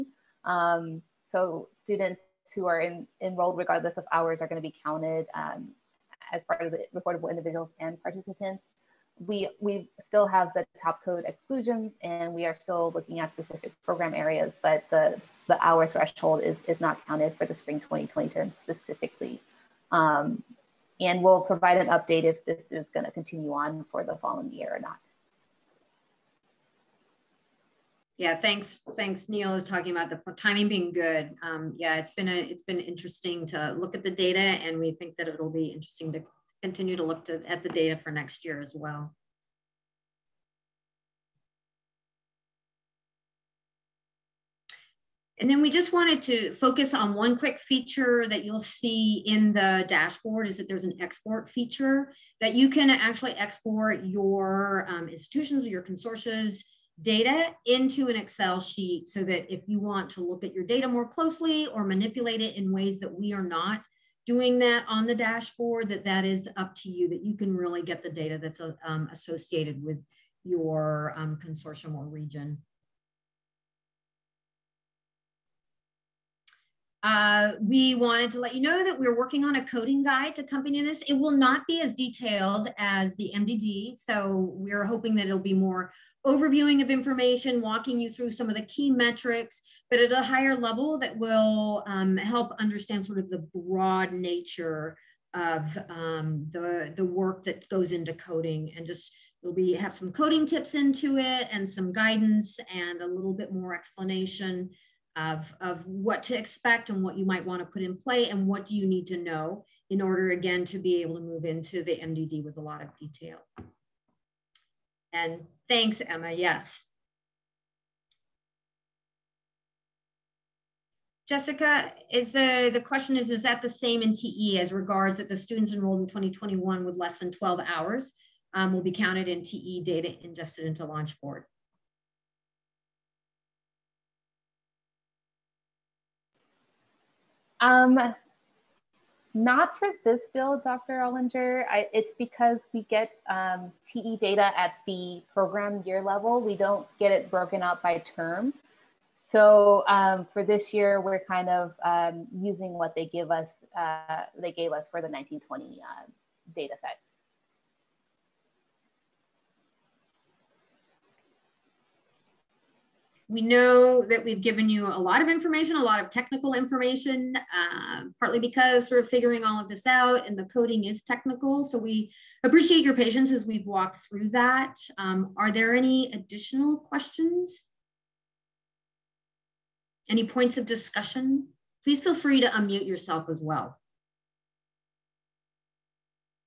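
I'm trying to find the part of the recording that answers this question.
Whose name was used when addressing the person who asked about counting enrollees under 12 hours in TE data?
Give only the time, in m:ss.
2:20.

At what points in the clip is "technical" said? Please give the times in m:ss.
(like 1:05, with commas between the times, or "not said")
2:46, 2:51.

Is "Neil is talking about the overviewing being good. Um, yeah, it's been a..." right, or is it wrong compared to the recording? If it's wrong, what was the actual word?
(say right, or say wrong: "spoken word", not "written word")
wrong: "timing", not "overviewing".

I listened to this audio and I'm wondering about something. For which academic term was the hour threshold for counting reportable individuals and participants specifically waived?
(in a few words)
Spring 2020.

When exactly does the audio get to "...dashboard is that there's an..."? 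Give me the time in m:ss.
0:49.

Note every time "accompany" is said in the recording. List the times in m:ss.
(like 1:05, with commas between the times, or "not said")
1:20.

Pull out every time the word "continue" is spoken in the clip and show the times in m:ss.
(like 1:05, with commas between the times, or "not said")
0:23, 0:36.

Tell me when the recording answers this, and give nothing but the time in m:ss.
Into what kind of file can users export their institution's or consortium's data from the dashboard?
0:58.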